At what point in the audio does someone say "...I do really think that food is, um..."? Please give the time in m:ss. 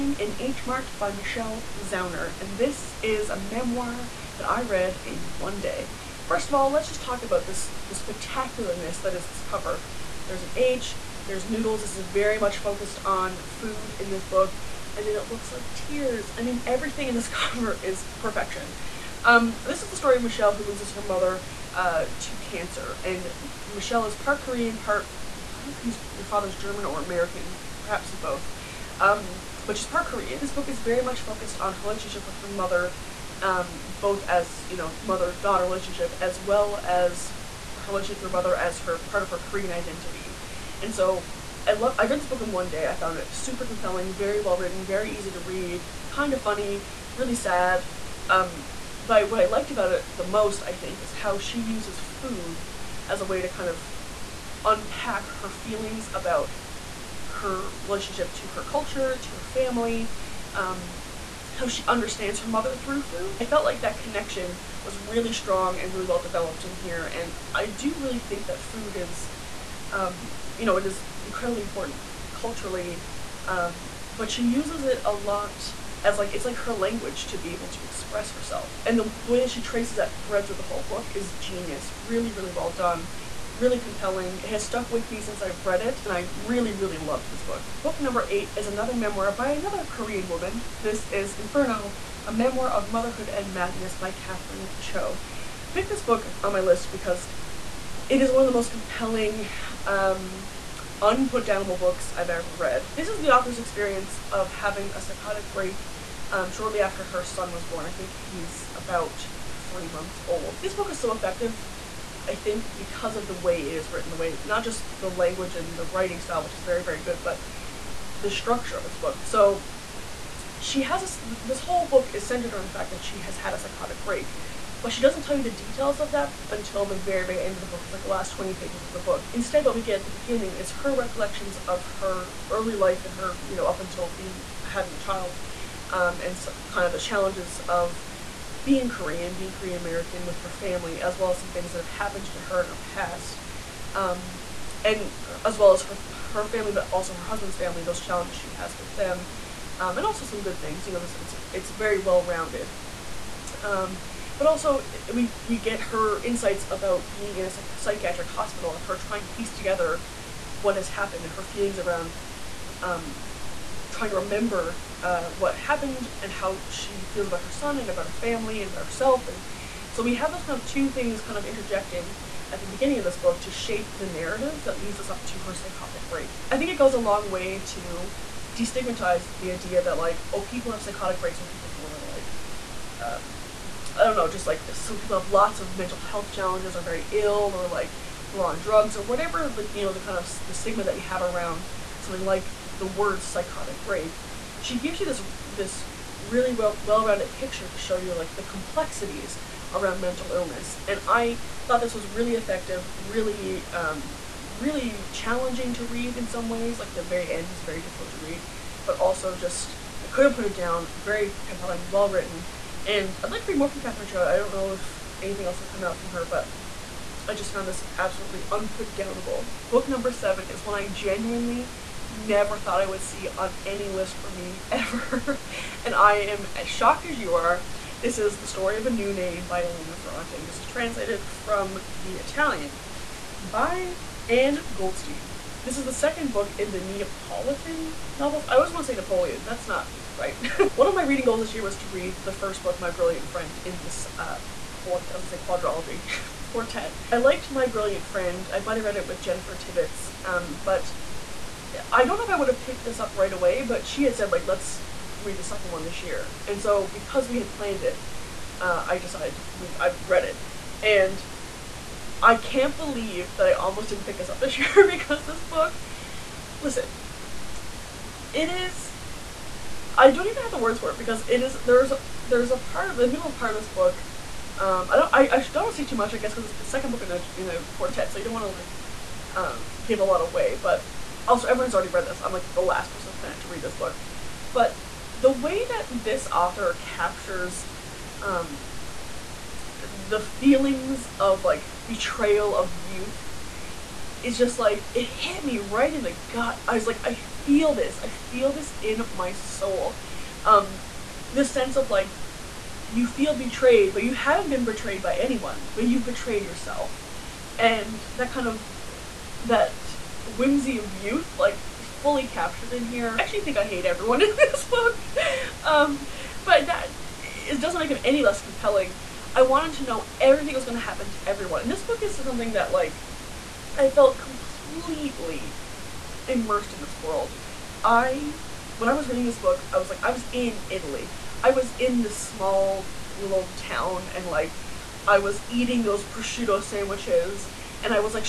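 1:07.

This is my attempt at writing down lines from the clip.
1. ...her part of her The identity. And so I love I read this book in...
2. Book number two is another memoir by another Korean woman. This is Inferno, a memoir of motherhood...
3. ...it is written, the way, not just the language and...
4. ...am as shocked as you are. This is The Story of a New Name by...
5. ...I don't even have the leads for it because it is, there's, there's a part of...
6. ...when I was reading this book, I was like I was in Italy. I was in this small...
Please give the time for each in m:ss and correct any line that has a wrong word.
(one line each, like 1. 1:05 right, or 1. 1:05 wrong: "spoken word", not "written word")
1. 0:38 wrong: "Korean", not "The"
2. 1:27 wrong: "eight", not "two"
3. 1:53 right
4. 3:46 right
5. 4:29 wrong: "words", not "leads"
6. 5:28 right.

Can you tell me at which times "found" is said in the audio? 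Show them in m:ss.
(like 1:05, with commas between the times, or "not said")
0:42, 3:37.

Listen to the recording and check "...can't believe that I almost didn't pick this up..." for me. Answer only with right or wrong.
right.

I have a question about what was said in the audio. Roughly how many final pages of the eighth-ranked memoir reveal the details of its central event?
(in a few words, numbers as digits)
20.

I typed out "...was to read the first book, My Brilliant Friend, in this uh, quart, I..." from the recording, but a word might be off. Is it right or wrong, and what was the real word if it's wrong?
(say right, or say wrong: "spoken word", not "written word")
right.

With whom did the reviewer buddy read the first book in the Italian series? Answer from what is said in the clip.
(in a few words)
Jennifer Tibbetts.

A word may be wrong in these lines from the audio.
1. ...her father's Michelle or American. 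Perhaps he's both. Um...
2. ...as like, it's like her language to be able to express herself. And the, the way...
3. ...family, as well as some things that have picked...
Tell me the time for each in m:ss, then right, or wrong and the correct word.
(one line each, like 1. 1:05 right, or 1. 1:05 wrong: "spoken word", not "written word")
1. 0:26 wrong: "German", not "Michelle"
2. 1:16 right
3. 2:20 wrong: "happened", not "picked".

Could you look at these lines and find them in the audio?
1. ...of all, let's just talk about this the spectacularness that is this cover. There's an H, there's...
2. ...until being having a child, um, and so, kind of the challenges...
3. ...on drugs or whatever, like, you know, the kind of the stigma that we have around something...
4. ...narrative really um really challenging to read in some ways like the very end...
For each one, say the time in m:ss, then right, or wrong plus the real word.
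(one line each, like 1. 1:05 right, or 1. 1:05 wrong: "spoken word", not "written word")
1. 0:06 right
2. 2:13 right
3. 3:08 right
4. 3:22 wrong: "effective", not "narrative".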